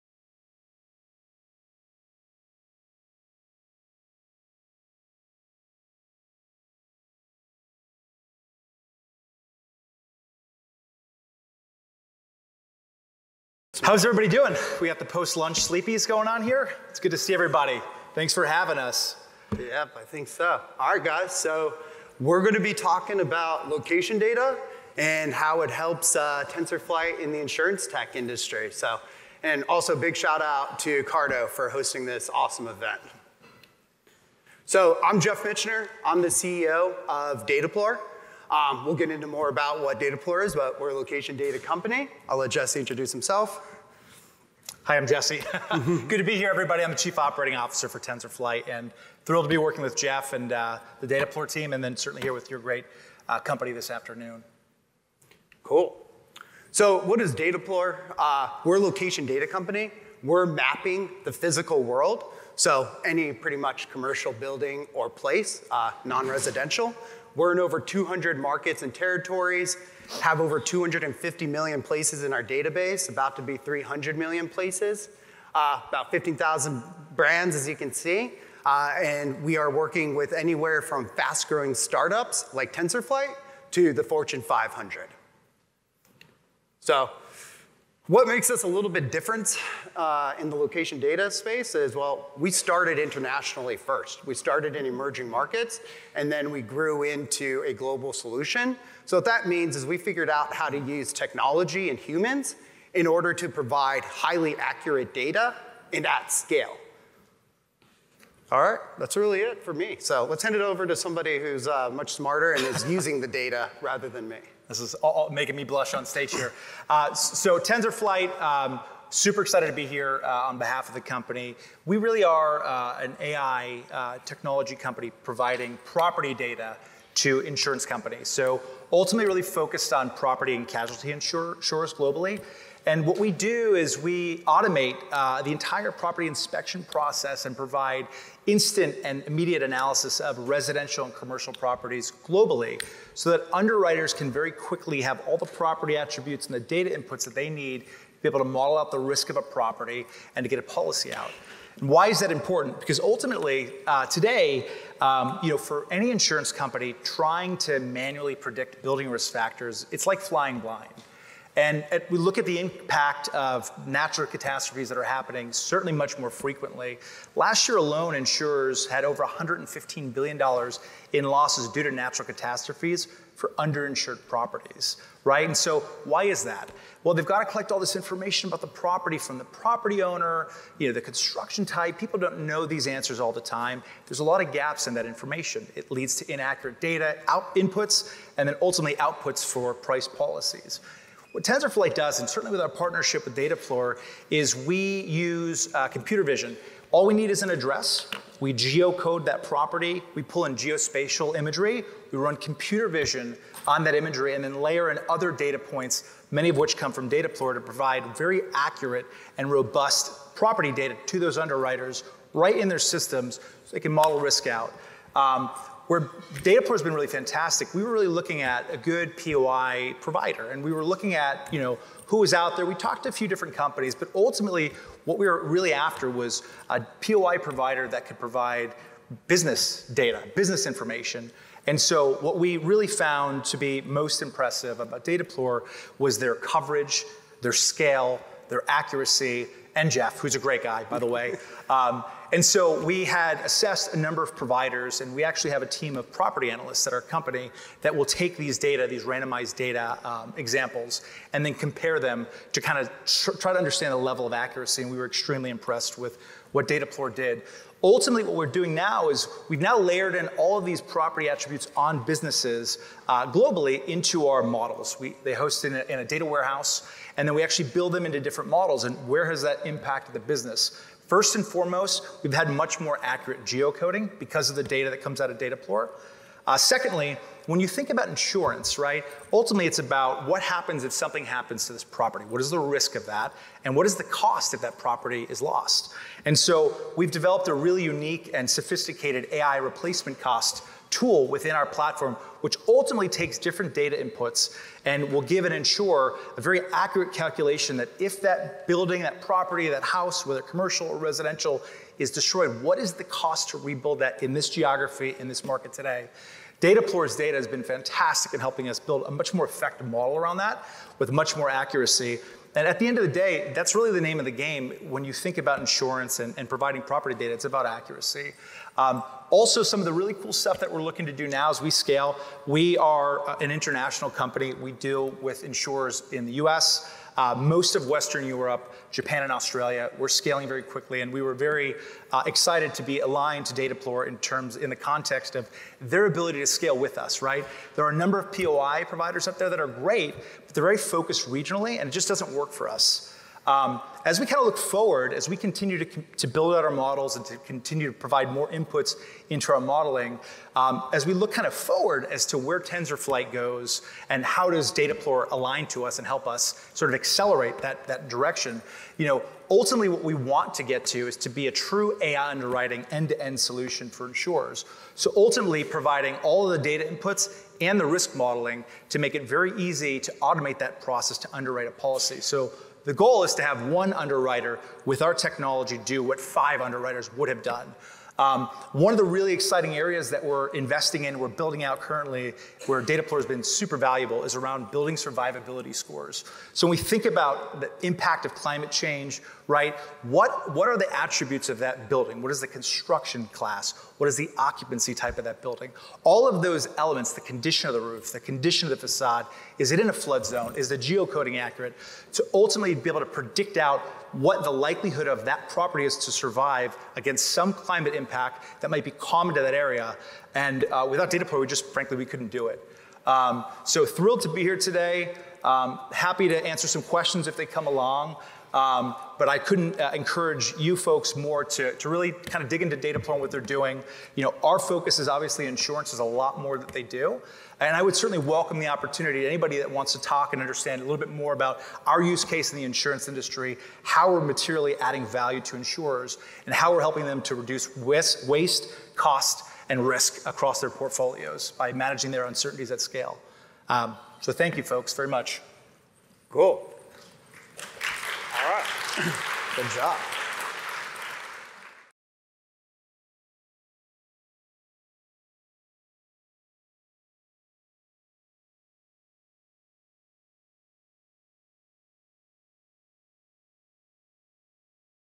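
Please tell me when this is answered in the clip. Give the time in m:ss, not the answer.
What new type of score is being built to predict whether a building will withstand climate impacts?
6:24.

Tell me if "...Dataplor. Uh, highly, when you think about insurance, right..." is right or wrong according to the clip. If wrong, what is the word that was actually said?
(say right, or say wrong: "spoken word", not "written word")
wrong: "secondly", not "highly".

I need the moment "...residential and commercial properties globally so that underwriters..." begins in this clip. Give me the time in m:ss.
2:20.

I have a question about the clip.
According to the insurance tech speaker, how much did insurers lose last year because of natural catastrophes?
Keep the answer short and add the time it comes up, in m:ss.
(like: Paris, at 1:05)
$115 billion, at 2:49.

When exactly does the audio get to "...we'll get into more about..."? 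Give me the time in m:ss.
0:38.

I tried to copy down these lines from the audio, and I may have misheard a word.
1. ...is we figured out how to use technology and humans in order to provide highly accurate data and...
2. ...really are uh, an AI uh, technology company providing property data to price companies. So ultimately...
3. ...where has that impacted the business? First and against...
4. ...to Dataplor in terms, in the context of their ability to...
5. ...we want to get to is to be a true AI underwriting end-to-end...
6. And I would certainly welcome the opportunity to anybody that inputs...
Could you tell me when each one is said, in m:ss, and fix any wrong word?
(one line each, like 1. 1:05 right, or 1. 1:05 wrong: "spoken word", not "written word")
1. 1:39 right
2. 2:01 wrong: "insurance", not "price"
3. 4:29 wrong: "foremost", not "against"
4. 5:33 right
5. 6:00 right
6. 7:07 wrong: "wants", not "inputs".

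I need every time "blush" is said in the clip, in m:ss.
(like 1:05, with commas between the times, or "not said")
1:55.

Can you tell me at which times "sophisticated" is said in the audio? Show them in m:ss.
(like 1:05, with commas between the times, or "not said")
4:48.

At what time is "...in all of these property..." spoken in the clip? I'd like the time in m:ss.
4:20.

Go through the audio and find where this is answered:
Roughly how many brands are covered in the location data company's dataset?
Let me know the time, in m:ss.
1:16.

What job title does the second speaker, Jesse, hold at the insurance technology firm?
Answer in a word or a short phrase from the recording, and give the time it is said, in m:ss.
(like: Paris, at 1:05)
Chief Operating Officer, at 0:46.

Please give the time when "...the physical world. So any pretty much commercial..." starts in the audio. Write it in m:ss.
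1:01.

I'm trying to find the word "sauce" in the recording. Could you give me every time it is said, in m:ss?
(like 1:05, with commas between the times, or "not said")
not said.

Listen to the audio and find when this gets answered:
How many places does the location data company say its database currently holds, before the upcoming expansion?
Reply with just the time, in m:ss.
1:10.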